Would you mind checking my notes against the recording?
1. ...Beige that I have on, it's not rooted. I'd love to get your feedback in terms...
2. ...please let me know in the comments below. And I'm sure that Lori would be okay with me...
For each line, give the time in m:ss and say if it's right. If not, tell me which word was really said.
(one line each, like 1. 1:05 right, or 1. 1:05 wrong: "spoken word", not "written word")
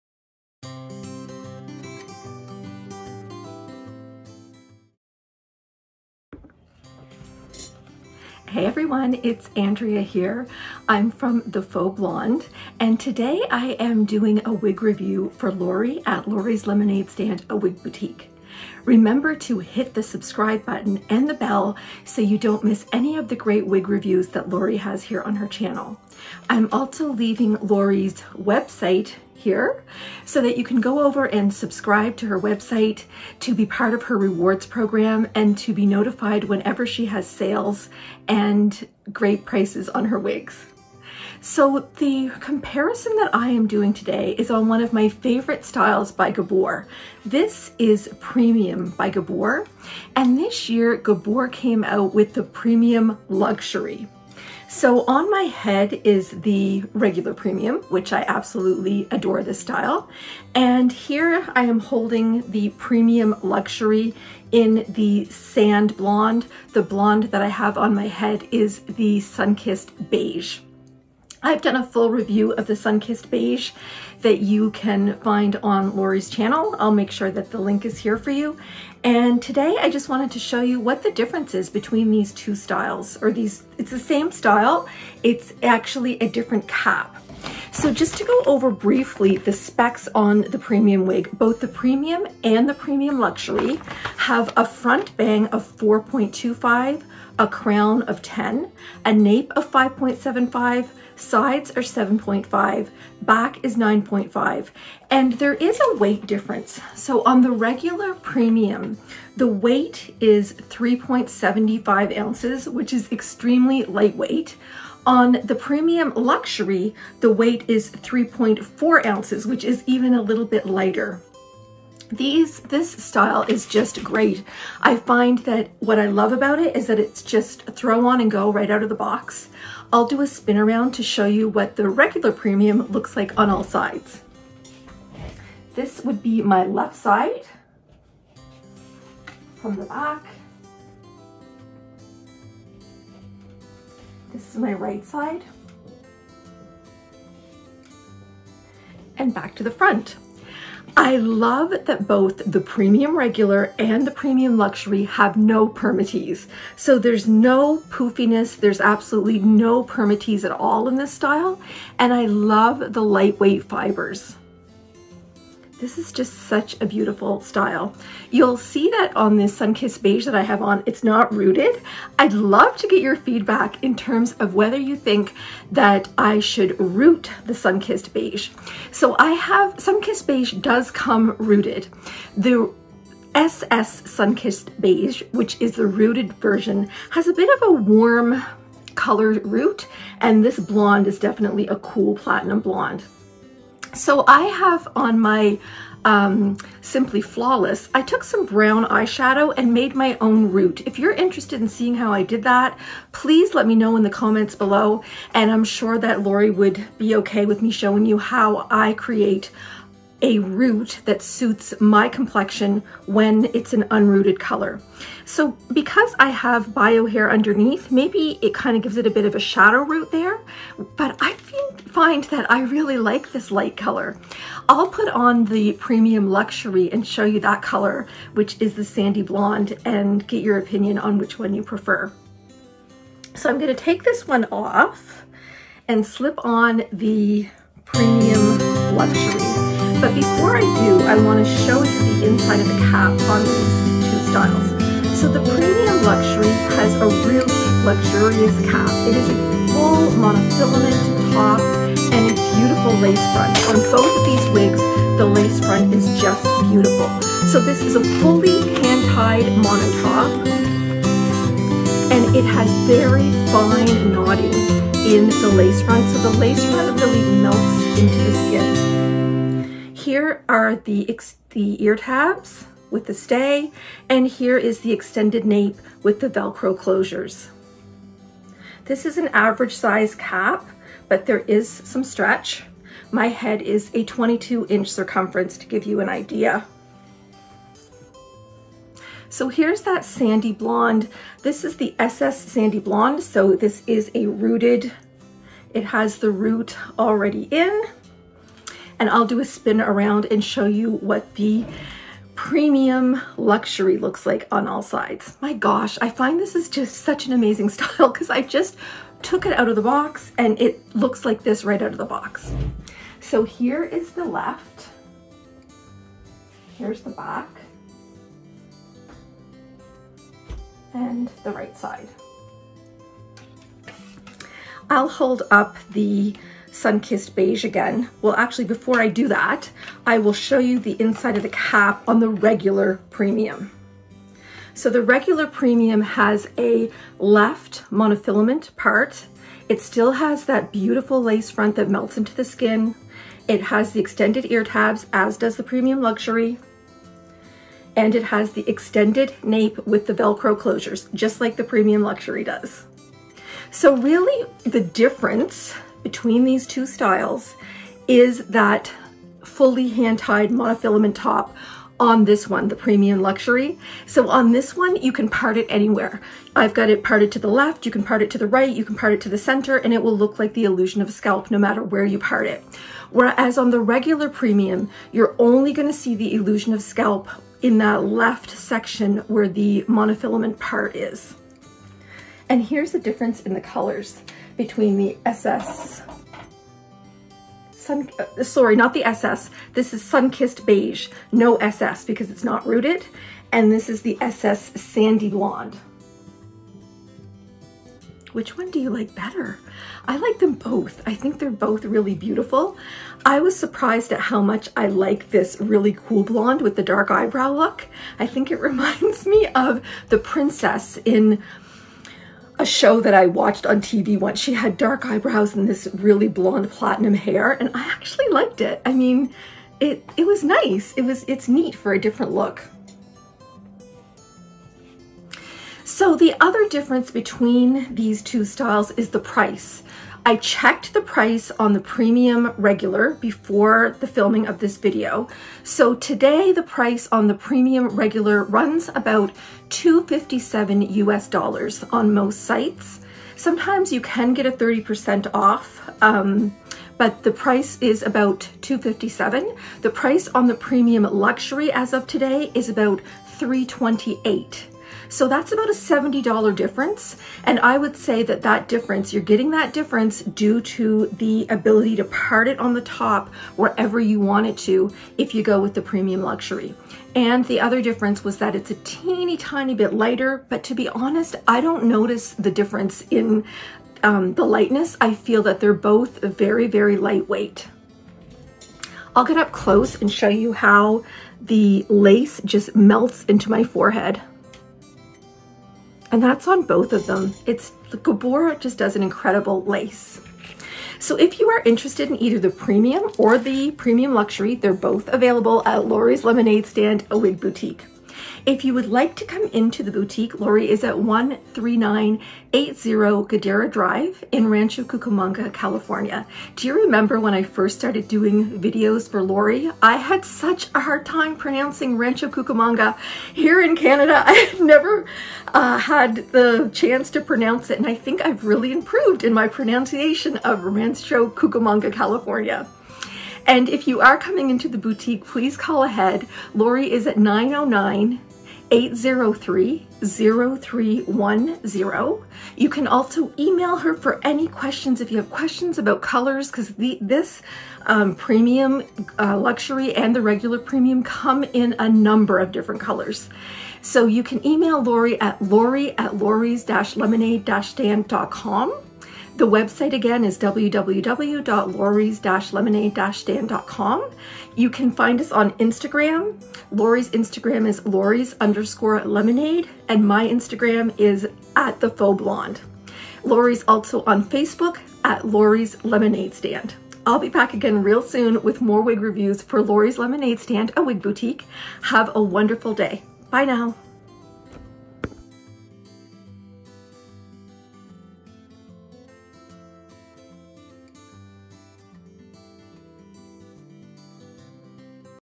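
1. 2:50 right
2. 3:23 right.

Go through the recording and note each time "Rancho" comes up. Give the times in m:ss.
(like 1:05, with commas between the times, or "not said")
8:24, 8:31, 8:40.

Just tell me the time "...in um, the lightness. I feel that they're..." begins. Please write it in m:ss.
7:53.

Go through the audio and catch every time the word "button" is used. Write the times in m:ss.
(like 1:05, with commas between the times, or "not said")
0:20.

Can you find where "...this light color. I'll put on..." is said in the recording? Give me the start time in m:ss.
3:43.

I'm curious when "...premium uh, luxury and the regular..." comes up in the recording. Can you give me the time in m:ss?
8:58.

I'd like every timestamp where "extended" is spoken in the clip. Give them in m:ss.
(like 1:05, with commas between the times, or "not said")
4:34, 5:43, 5:48.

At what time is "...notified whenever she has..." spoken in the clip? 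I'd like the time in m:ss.
0:35.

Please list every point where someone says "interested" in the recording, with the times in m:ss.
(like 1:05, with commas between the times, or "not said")
3:21, 8:11.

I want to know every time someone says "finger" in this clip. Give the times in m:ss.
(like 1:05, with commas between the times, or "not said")
not said.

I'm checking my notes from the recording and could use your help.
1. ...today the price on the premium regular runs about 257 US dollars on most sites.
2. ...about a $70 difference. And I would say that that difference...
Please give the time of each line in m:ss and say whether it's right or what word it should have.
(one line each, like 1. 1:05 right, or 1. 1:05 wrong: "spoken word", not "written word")
1. 7:15 right
2. 7:35 right.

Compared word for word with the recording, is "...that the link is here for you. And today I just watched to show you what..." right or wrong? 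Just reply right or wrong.
wrong.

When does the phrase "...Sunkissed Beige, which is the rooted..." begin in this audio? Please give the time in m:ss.
3:04.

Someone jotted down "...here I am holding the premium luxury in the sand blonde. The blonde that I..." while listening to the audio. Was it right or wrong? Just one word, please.
right.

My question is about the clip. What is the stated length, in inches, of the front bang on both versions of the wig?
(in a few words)
4.25.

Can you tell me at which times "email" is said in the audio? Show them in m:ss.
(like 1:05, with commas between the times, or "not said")
8:53, 9:04.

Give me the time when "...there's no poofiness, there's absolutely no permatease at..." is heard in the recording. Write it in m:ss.
2:36.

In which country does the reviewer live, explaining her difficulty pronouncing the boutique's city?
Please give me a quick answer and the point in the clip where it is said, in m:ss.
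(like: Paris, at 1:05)
Canada, at 8:33.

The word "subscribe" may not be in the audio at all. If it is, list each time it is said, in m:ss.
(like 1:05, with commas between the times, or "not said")
0:20, 0:31.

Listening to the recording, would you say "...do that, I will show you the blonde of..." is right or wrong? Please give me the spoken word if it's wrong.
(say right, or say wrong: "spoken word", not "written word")
wrong: "inside", not "blonde".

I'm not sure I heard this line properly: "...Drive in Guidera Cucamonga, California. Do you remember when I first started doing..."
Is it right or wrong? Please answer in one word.
wrong.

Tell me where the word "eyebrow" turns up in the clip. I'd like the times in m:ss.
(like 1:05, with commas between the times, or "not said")
6:47, 6:55.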